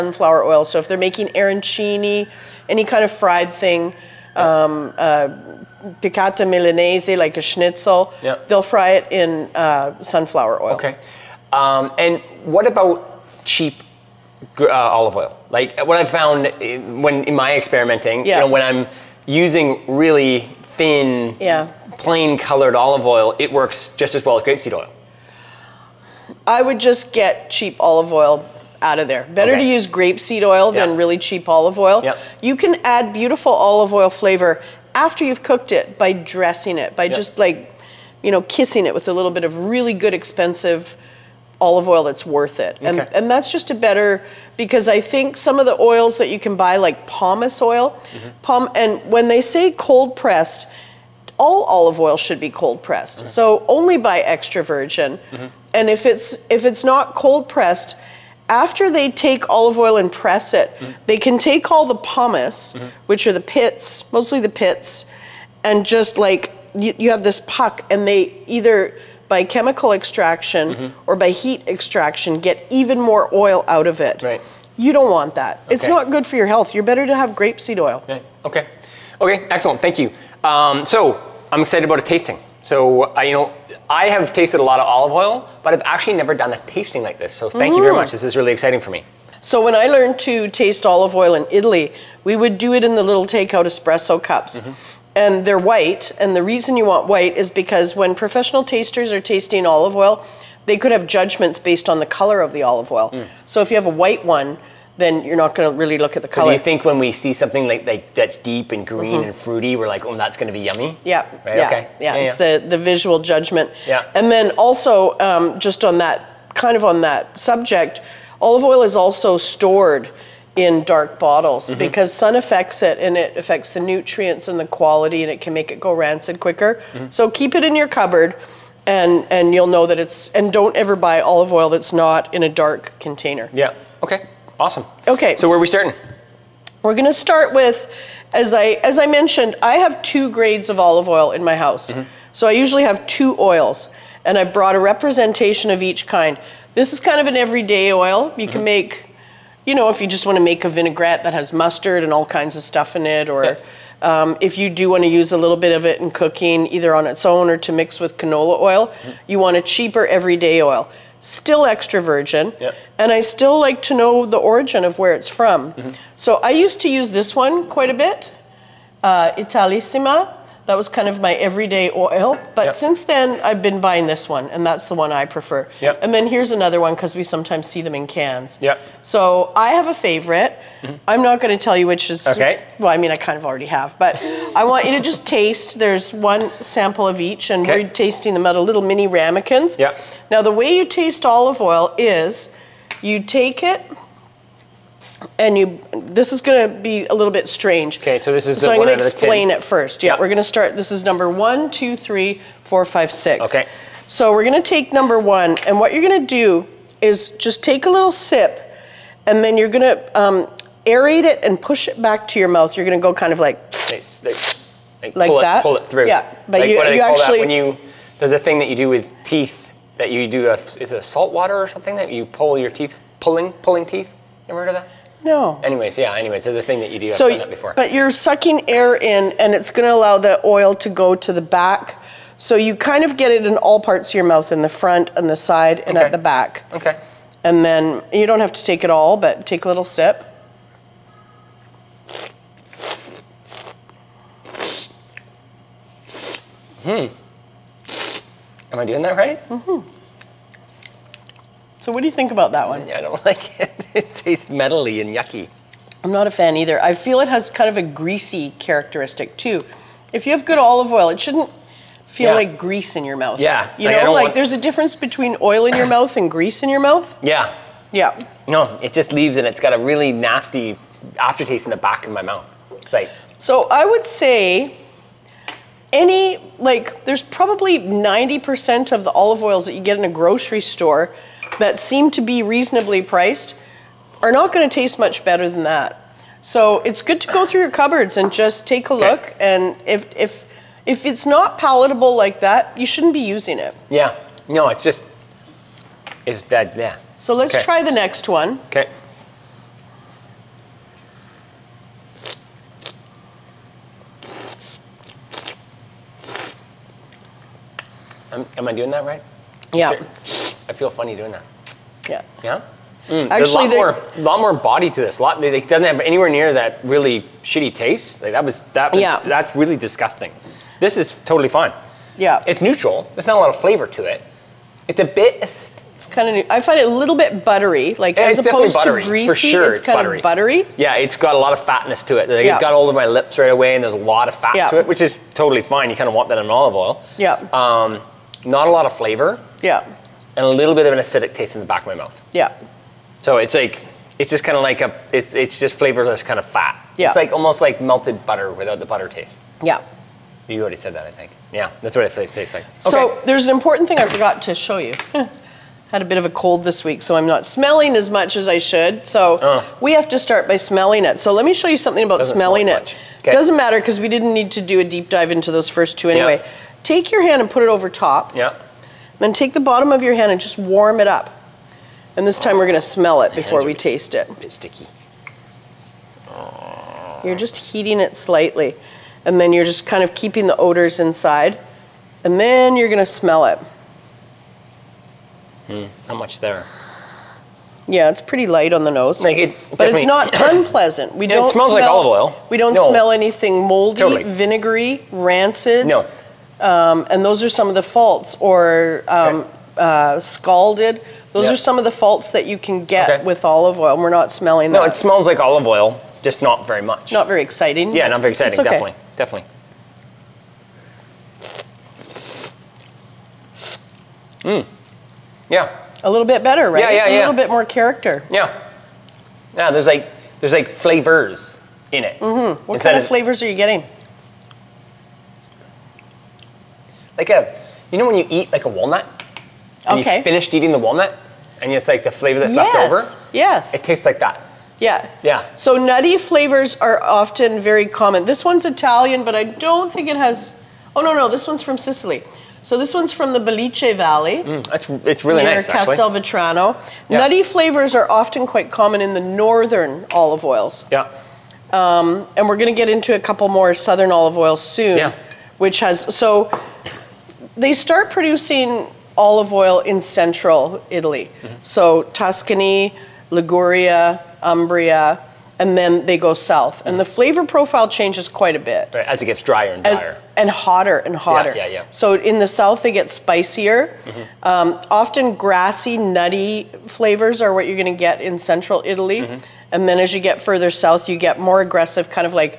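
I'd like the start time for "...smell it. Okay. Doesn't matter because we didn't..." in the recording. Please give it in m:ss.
6:02.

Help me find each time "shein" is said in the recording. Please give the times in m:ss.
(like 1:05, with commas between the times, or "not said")
not said.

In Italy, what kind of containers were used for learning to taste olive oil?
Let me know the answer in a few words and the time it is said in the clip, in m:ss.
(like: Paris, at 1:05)
Takeout espresso cups, at 1:33.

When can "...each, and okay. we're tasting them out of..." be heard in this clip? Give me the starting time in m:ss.
3:07.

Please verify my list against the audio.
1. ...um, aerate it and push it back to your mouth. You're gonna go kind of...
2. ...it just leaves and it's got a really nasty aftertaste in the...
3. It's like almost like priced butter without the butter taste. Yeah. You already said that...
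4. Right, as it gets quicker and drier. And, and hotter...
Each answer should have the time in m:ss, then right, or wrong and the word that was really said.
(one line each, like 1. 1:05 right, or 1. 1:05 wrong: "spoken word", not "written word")
1. 3:30 right
2. 4:28 right
3. 5:47 wrong: "melted", not "priced"
4. 7:48 wrong: "drier", not "quicker".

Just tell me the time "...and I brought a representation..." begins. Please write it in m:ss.
2:24.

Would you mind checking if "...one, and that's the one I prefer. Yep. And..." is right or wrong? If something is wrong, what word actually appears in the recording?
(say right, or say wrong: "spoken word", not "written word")
right.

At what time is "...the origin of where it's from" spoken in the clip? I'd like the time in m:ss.
2:44.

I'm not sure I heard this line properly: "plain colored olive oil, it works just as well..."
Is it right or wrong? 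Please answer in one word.
right.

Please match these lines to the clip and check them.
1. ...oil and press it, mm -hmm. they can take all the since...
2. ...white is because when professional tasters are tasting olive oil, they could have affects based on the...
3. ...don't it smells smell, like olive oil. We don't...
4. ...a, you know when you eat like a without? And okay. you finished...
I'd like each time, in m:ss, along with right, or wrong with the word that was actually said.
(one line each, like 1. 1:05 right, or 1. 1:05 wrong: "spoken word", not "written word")
1. 0:59 wrong: "pomace", not "since"
2. 1:37 wrong: "judgments", not "affects"
3. 6:31 right
4. 7:07 wrong: "walnut", not "without".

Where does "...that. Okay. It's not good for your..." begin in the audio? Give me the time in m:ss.
1:15.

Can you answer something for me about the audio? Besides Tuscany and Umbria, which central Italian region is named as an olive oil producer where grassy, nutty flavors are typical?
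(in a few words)
Liguria.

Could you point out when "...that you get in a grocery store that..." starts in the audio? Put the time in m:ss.
4:39.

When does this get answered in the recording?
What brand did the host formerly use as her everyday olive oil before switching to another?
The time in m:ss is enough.
2:49.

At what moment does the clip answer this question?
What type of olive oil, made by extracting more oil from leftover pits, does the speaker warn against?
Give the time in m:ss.
0:47.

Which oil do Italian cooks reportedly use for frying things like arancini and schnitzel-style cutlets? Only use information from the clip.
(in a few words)
Sunflower oil.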